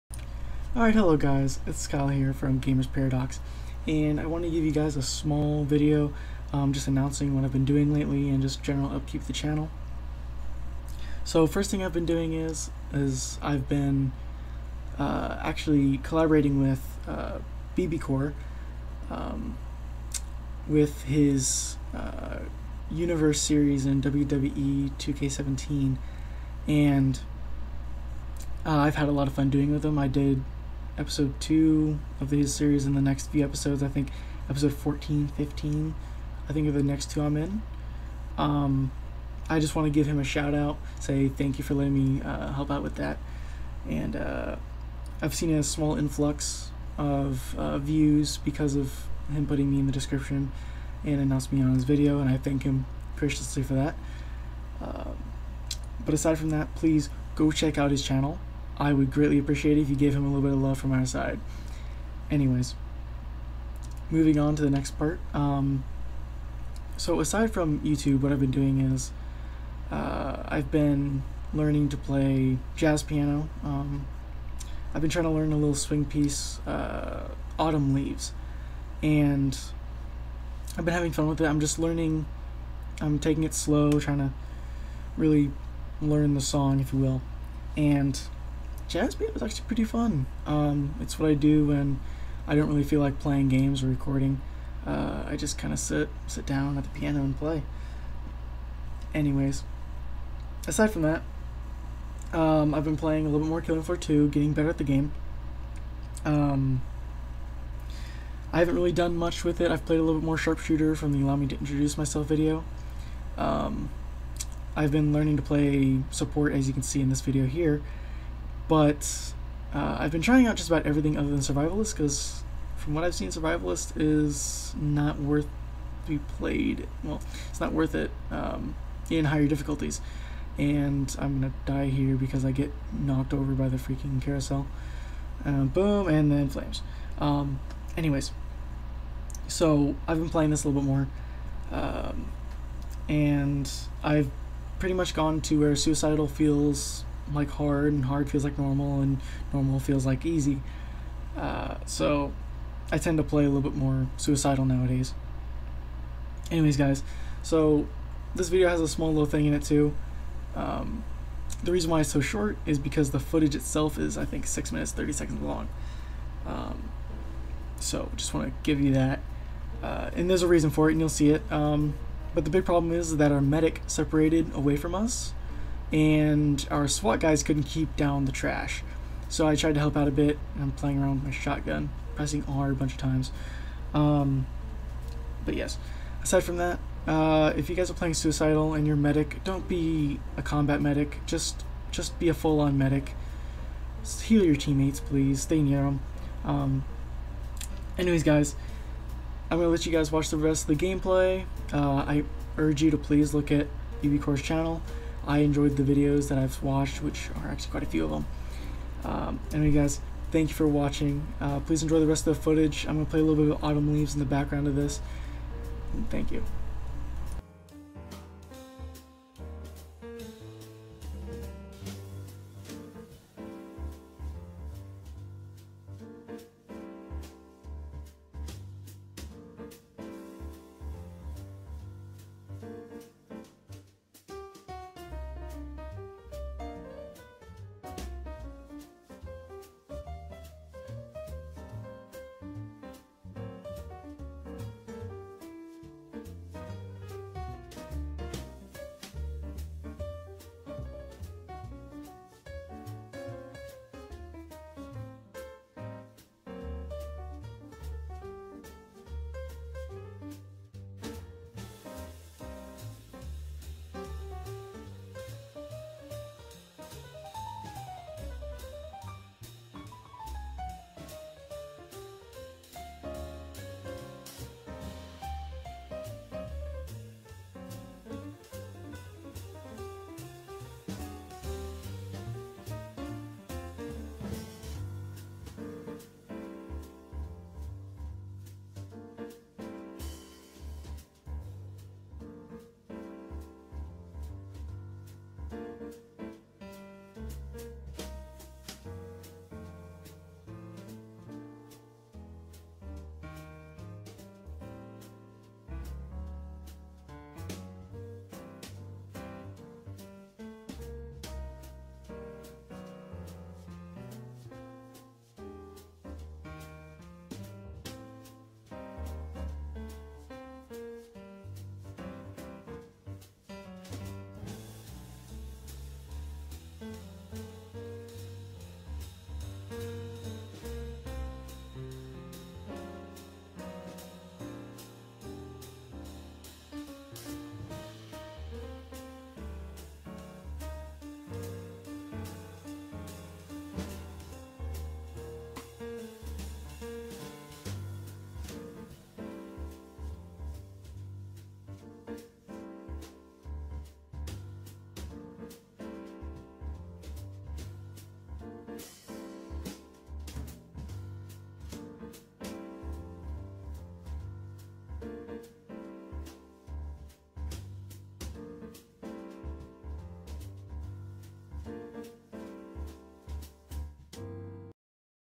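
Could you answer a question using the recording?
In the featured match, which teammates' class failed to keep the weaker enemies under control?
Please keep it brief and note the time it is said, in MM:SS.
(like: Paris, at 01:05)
SWAT, at 02:56.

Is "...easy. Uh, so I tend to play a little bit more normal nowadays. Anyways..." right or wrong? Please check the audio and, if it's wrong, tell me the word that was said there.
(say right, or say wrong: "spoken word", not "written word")
wrong: "suicidal", not "normal".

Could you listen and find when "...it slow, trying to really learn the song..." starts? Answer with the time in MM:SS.
01:23.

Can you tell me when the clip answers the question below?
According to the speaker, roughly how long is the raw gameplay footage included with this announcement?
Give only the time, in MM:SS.
02:44.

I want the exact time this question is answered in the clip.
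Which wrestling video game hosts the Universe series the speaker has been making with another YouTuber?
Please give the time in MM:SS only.
00:24.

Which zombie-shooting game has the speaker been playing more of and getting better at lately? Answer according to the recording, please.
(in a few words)
Killing Floor 2.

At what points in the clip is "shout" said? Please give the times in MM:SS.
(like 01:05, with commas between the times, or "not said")
00:40.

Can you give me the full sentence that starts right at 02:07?
Well, it's not worth it um, in higher difficulties.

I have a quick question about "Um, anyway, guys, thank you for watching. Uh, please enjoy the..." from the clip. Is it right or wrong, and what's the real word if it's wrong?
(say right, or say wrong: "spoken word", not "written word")
right.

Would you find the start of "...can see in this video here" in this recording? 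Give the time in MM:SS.
01:56.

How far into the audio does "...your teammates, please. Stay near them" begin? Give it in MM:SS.
03:14.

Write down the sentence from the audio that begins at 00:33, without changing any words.
I think episode 14, 15, I think are the next two I'm in.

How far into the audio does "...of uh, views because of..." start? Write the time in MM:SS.
00:46.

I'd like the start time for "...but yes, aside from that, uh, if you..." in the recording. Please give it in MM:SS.
03:05.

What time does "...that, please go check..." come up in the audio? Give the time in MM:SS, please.
00:56.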